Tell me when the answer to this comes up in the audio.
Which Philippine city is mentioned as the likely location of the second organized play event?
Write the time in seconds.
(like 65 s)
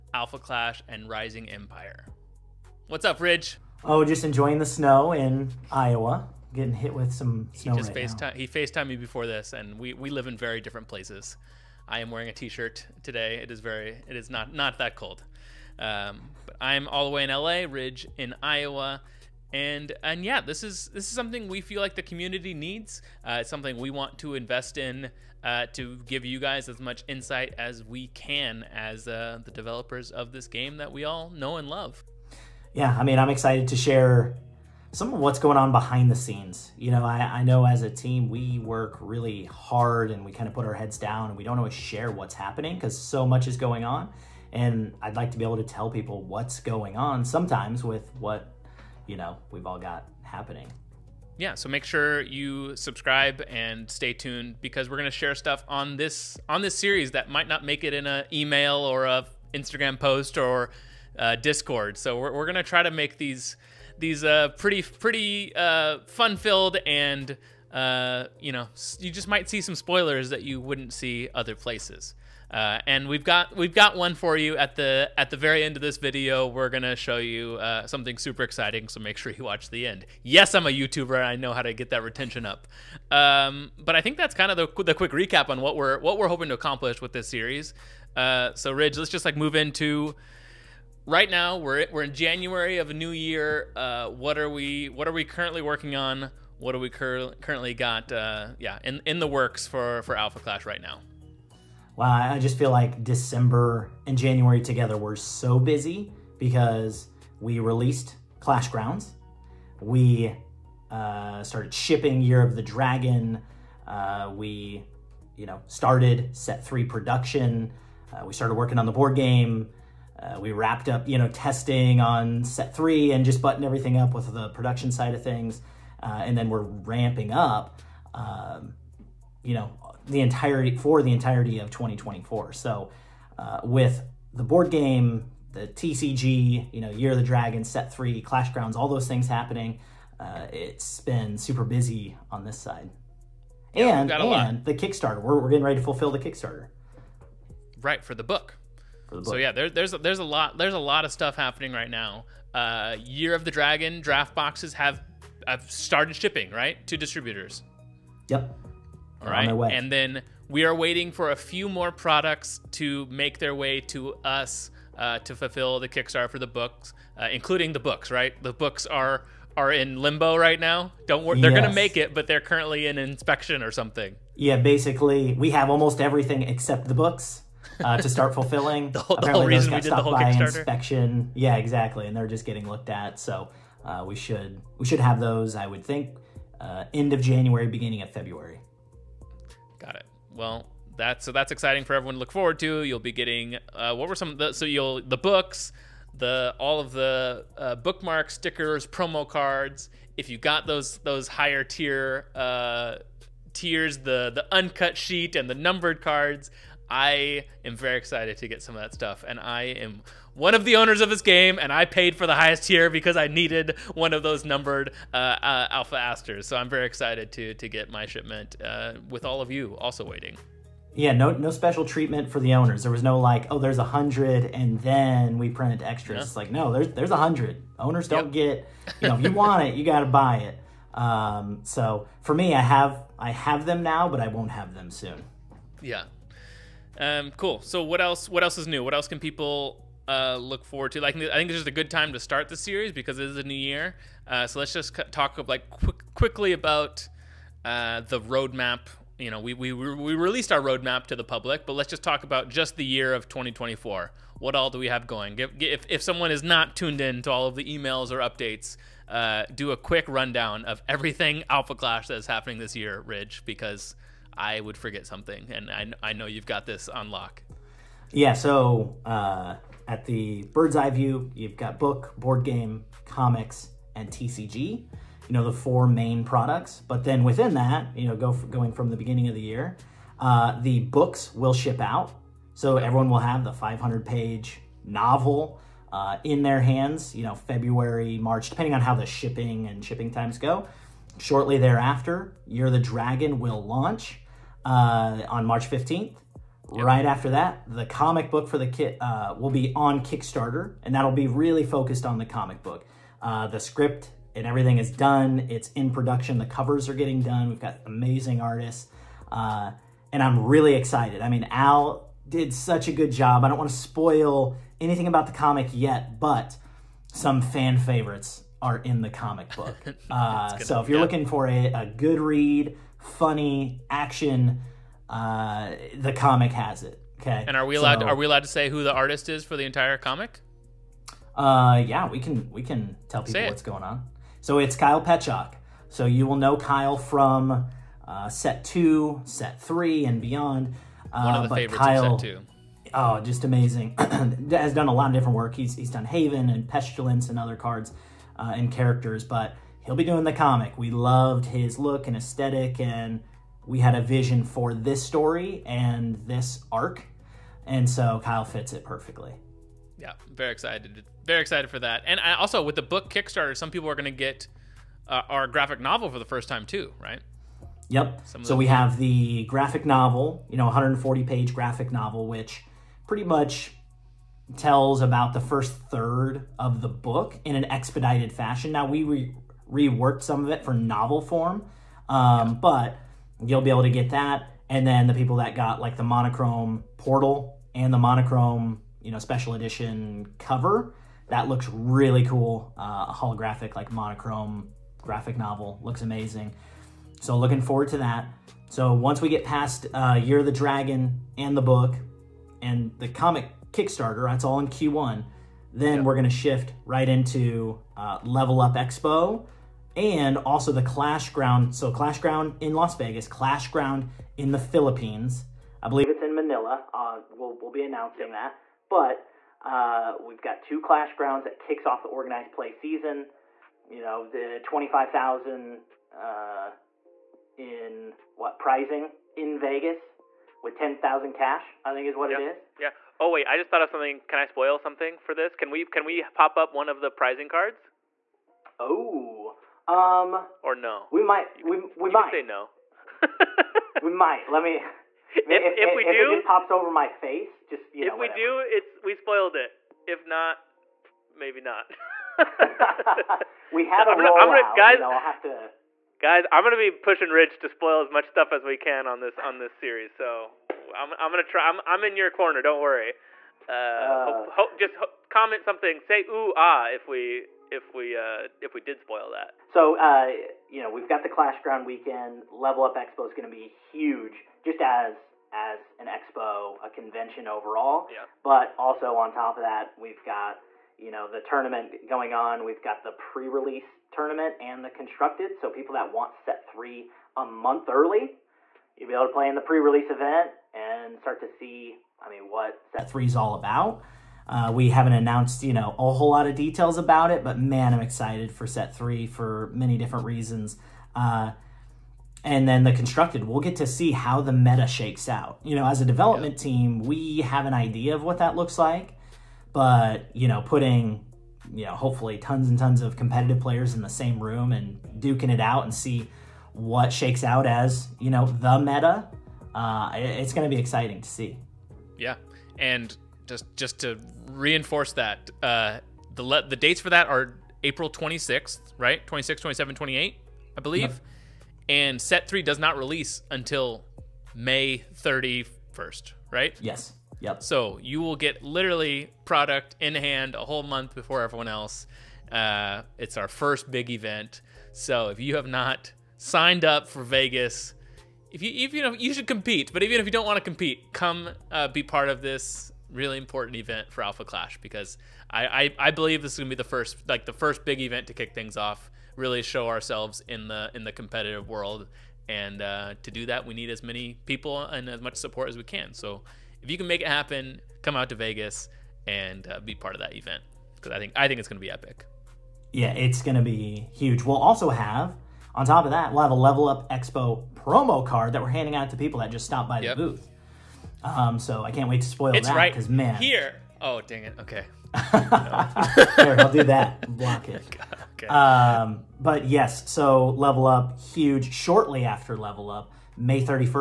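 416 s.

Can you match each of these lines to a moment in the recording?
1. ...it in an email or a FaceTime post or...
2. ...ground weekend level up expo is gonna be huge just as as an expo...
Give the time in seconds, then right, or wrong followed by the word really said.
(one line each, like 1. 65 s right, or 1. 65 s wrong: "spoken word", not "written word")
1. 57 s wrong: "Instagram", not "FaceTime"
2. 471 s right.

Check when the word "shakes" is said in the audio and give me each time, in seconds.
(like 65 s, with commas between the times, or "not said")
504 s, 517 s.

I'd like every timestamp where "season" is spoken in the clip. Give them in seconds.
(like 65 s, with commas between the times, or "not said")
422 s.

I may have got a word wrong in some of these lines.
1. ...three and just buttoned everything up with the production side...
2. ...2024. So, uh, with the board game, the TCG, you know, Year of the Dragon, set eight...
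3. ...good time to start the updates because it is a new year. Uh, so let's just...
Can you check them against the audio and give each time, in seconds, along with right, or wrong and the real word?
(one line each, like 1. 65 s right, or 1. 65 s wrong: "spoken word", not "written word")
1. 122 s right
2. 131 s wrong: "three", not "eight"
3. 241 s wrong: "series", not "updates".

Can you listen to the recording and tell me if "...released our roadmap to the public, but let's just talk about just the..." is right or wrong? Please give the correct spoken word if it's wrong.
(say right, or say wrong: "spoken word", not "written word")
right.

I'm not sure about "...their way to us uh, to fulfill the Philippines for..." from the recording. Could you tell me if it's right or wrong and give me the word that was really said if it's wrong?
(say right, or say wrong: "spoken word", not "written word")
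wrong: "Kickstarter", not "Philippines".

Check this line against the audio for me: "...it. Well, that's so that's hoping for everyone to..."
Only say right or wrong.
wrong.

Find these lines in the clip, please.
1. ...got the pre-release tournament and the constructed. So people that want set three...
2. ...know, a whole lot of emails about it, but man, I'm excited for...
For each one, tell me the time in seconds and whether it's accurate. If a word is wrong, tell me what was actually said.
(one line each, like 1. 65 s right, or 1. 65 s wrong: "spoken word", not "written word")
1. 482 s right
2. 495 s wrong: "details", not "emails".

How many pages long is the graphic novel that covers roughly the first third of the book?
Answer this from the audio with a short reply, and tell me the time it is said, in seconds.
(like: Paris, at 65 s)
140, at 370 s.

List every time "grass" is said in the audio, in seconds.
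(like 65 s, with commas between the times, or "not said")
not said.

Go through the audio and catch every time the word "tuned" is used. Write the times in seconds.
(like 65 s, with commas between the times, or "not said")
54 s, 256 s.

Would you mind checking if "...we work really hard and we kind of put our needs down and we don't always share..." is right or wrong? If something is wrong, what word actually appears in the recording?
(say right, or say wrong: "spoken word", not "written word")
wrong: "heads", not "needs".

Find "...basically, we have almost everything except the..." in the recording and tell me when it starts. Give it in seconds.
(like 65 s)
174 s.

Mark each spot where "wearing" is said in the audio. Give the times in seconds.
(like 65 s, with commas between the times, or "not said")
12 s.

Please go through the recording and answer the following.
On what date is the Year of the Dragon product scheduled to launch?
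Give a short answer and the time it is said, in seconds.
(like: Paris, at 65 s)
March 15th, at 295 s.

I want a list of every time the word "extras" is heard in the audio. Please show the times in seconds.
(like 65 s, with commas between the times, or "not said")
225 s.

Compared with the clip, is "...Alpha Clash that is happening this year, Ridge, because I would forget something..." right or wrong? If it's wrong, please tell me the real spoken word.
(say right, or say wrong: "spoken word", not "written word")
right.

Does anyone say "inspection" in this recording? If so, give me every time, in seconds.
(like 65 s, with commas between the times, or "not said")
172 s, 180 s.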